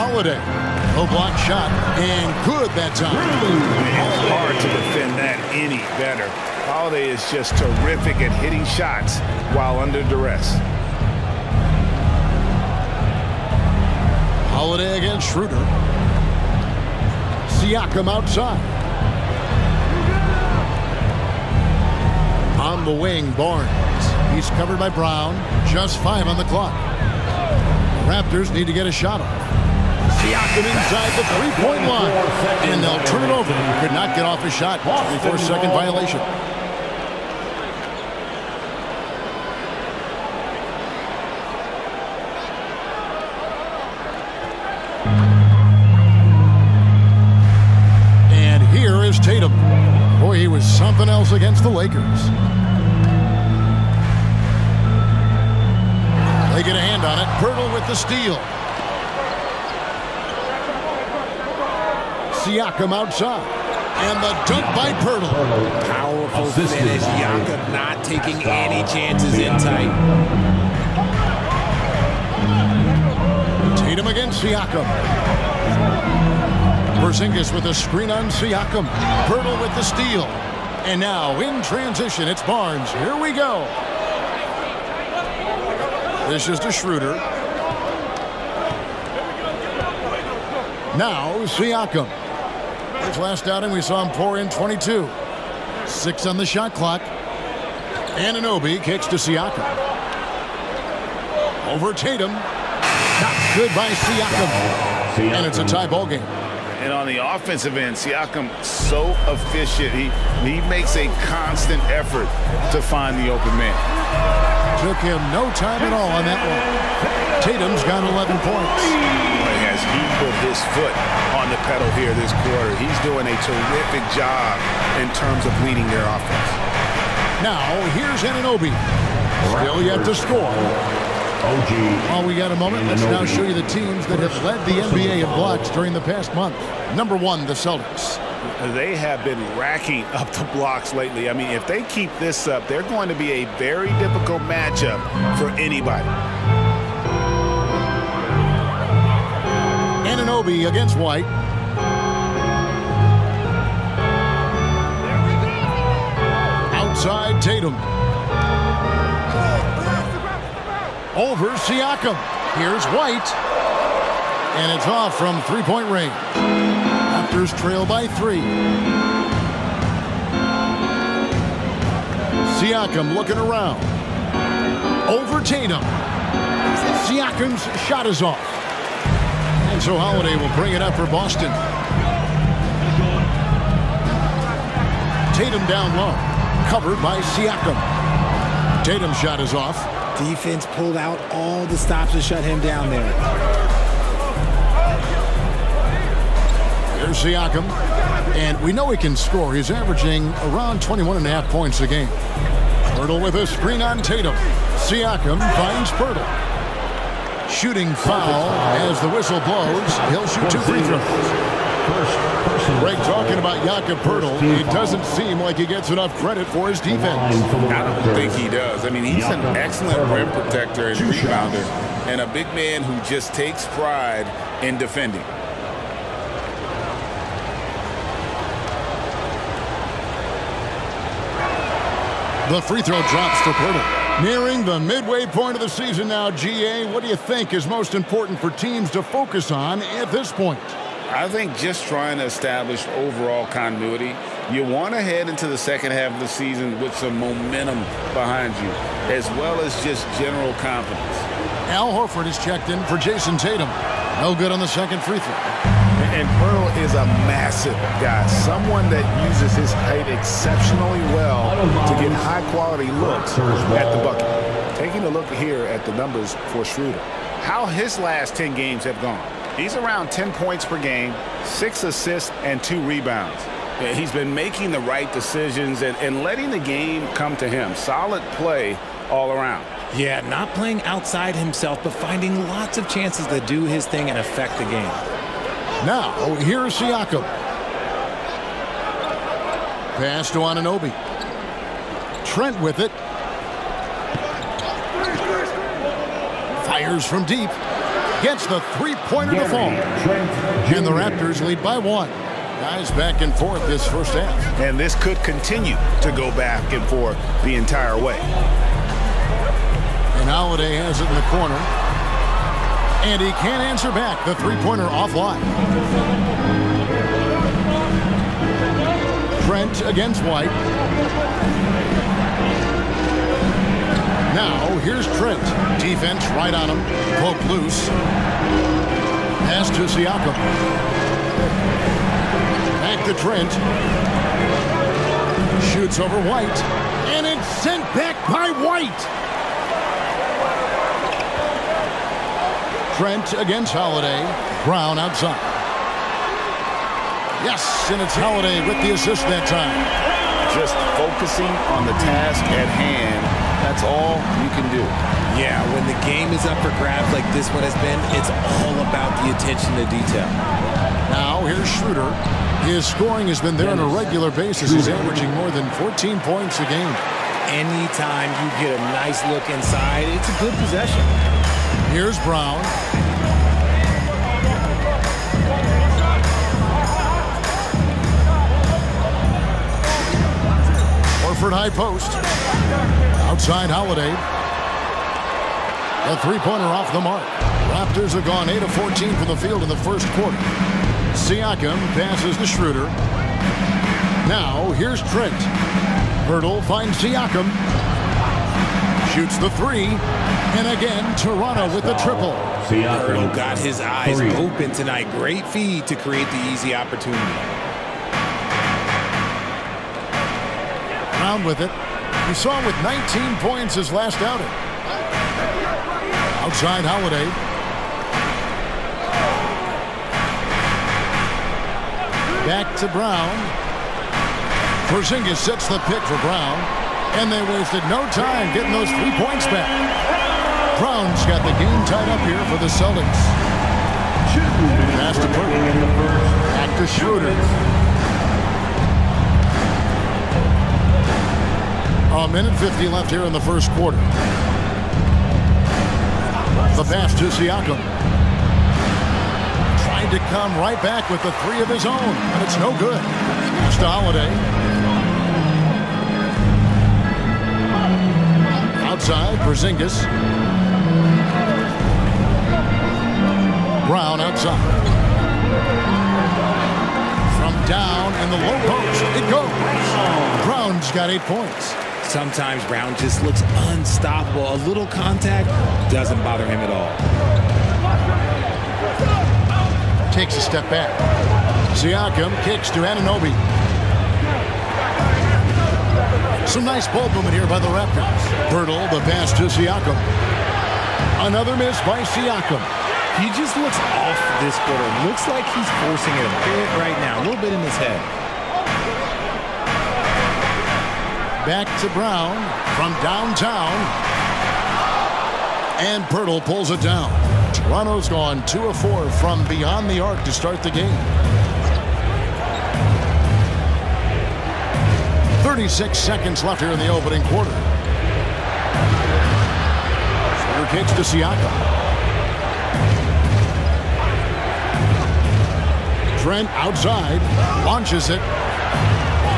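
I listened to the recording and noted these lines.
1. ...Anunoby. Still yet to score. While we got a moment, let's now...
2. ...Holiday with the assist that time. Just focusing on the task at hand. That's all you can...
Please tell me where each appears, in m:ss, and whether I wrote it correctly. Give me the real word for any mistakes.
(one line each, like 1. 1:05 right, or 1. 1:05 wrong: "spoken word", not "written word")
1. 2:08 right
2. 5:48 right.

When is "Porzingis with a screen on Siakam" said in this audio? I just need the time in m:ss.
1:16.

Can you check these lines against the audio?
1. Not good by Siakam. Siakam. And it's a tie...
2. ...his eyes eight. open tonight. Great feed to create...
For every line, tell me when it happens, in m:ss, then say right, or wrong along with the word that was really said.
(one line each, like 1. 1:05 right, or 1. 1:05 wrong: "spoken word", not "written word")
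1. 1:42 right
2. 6:43 wrong: "three", not "eight".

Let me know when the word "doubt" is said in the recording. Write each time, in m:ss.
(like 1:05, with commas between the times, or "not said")
not said.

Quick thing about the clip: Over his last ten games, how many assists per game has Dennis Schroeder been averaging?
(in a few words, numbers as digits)
6.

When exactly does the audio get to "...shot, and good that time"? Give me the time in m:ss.
0:01.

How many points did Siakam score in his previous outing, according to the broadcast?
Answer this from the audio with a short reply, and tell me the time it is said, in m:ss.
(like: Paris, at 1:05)
22, at 1:34.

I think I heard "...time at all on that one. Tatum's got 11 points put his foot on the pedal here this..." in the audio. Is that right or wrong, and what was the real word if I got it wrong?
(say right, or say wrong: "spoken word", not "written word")
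right.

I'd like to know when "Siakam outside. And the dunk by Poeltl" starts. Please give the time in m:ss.
1:02.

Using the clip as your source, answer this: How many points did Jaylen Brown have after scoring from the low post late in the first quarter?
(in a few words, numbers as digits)
8.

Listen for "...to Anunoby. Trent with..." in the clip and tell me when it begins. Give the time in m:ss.
4:50.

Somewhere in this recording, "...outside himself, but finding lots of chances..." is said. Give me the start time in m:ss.
4:40.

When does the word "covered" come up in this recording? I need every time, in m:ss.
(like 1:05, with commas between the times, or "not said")
0:24, 3:06.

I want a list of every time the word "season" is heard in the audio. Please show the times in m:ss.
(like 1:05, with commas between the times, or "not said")
3:55, 4:06.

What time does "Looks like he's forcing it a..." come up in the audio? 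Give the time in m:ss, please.
8:15.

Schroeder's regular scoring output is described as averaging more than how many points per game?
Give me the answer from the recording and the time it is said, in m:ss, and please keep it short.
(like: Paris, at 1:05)
14, at 6:05.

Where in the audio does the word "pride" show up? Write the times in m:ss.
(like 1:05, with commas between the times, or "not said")
3:43.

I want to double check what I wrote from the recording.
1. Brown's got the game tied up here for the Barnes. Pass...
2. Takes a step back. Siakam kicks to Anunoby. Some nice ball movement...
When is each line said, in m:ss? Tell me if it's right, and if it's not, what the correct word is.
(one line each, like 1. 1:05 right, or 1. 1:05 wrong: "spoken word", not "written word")
1. 7:10 wrong: "Celtics", not "Barnes"
2. 8:00 right.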